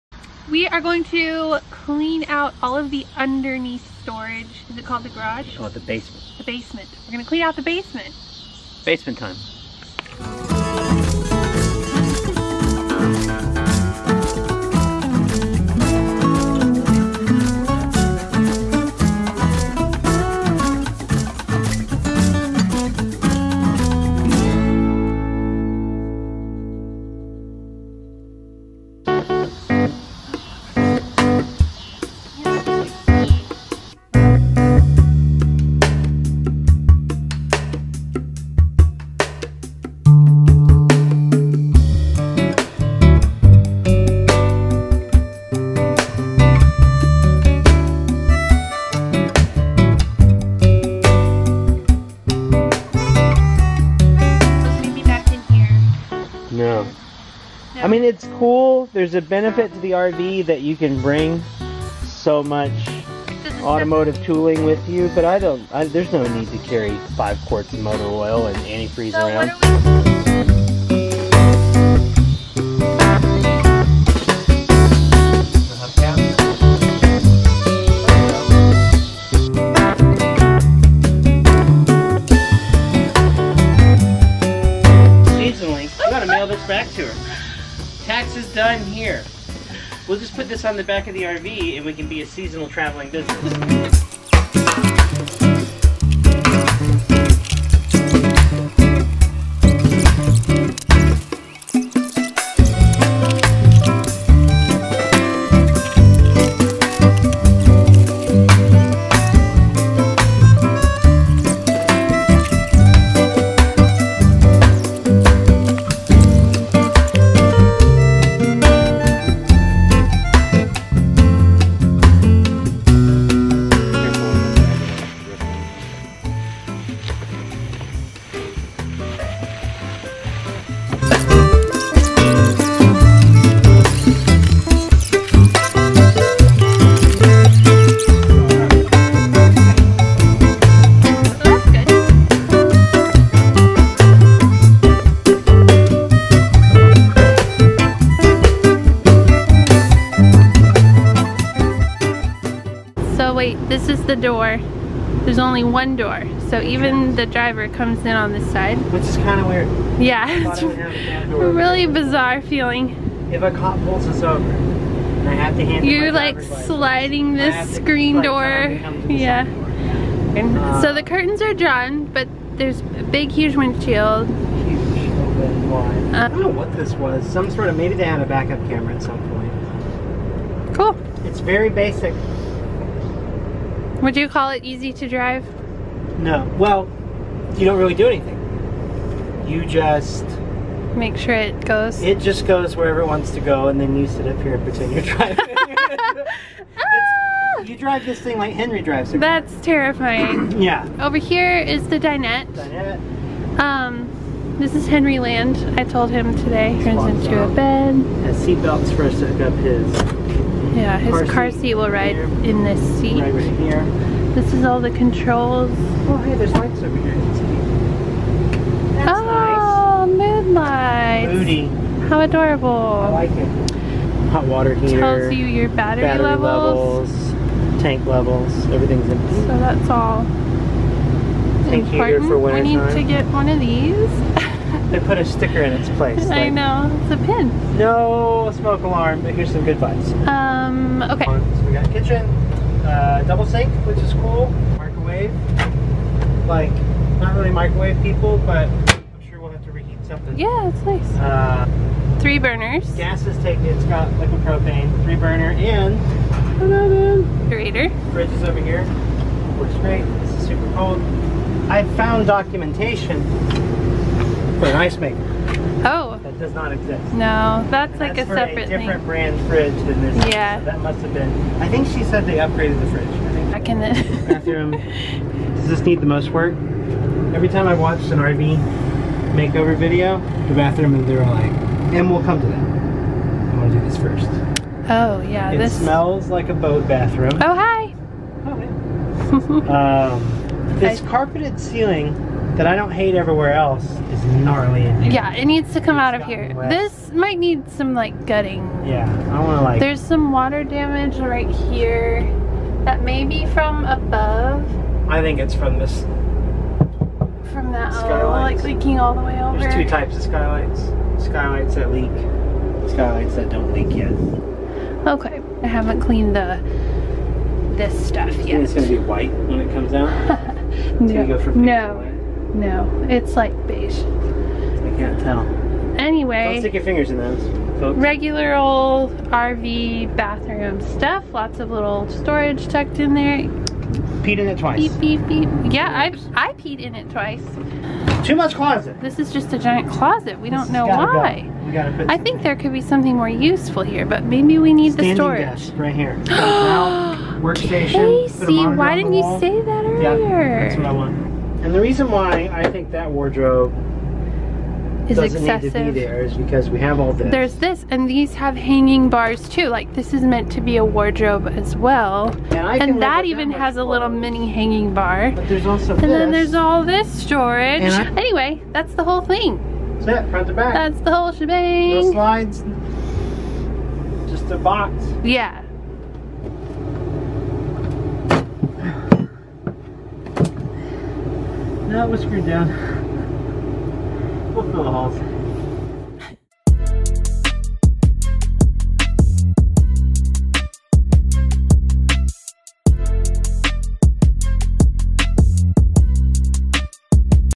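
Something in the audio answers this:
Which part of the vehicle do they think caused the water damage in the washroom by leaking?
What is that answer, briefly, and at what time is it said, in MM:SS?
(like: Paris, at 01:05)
Skylight, at 05:07.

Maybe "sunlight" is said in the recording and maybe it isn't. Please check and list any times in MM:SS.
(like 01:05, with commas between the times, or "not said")
not said.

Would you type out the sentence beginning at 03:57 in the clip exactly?
No smoke alarm, but here's some good vibes.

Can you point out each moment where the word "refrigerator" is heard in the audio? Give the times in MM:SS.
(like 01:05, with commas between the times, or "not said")
04:16.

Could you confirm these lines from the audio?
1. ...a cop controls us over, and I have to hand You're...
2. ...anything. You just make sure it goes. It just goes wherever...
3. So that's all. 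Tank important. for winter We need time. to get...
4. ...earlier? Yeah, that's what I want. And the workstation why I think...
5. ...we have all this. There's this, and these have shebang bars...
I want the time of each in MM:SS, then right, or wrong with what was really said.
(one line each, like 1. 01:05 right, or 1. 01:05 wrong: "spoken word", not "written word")
1. 02:43 wrong: "pulls", not "controls"
2. 03:08 right
3. 03:49 right
4. 05:49 wrong: "reason", not "workstation"
5. 05:56 wrong: "hanging", not "shebang".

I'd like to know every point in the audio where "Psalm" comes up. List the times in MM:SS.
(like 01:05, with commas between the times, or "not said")
not said.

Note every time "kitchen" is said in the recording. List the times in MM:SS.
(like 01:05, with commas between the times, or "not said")
04:01.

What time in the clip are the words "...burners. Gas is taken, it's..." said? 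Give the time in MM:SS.
04:12.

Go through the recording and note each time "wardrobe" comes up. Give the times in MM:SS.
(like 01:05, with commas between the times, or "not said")
05:53, 06:00.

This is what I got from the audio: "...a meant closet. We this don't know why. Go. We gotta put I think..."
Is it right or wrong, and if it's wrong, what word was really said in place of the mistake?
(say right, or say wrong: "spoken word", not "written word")
wrong: "giant", not "meant".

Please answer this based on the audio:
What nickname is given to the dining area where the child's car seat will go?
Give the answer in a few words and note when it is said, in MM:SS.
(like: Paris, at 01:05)
Henry Land, at 03:24.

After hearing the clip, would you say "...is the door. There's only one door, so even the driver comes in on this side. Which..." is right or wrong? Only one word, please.
right.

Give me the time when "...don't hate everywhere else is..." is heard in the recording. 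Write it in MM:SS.
04:52.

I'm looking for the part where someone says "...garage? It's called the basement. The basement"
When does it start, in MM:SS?
00:05.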